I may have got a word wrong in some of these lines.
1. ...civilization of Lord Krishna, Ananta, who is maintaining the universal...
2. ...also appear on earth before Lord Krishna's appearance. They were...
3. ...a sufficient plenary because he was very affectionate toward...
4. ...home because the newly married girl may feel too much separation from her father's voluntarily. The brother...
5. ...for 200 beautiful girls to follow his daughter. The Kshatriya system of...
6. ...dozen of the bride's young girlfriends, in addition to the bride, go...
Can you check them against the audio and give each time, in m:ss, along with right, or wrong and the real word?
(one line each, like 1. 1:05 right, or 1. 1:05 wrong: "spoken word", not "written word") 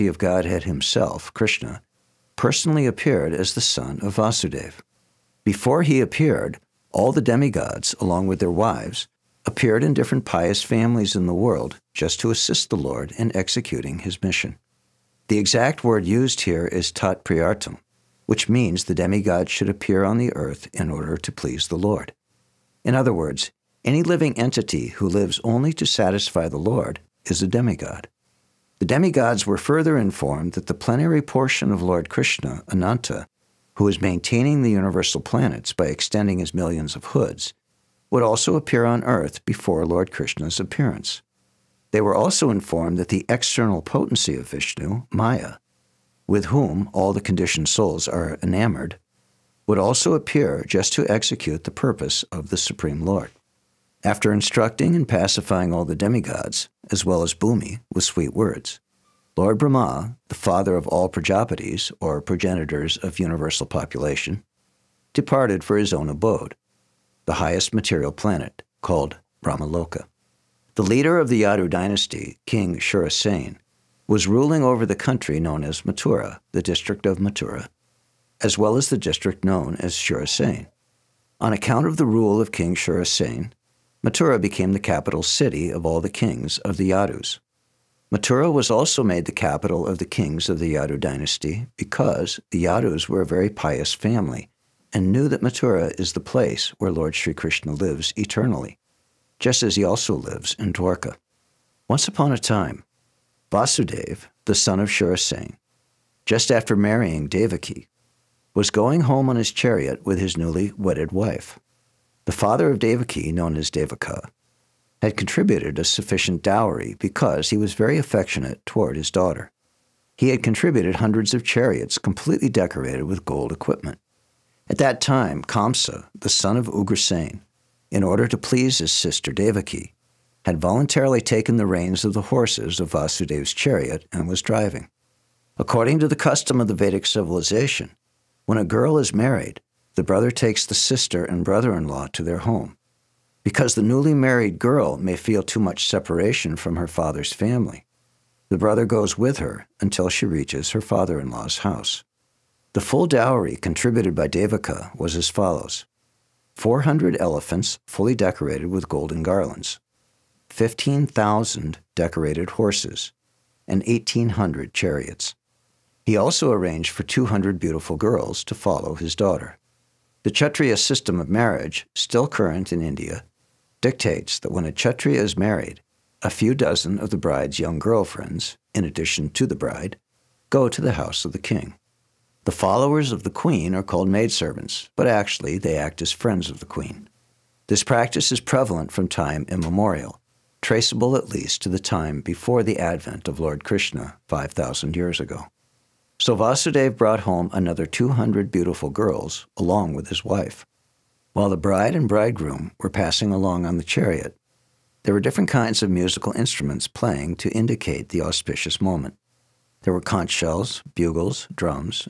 1. 0:31 wrong: "portion", not "civilization"
2. 0:38 right
3. 1:55 wrong: "dowry", not "plenary"
4. 2:22 wrong: "family", not "voluntarily"
5. 2:46 right
6. 2:56 right.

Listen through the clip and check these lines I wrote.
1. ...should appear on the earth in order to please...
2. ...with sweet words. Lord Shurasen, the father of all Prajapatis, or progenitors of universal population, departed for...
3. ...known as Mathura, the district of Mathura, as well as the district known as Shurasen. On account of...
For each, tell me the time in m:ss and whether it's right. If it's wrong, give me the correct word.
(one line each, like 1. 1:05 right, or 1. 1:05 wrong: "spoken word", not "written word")
1. 0:19 right
2. 0:57 wrong: "Brahma", not "Shurasen"
3. 1:15 right.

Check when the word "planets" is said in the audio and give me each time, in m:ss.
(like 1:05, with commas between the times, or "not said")
0:35, 1:08.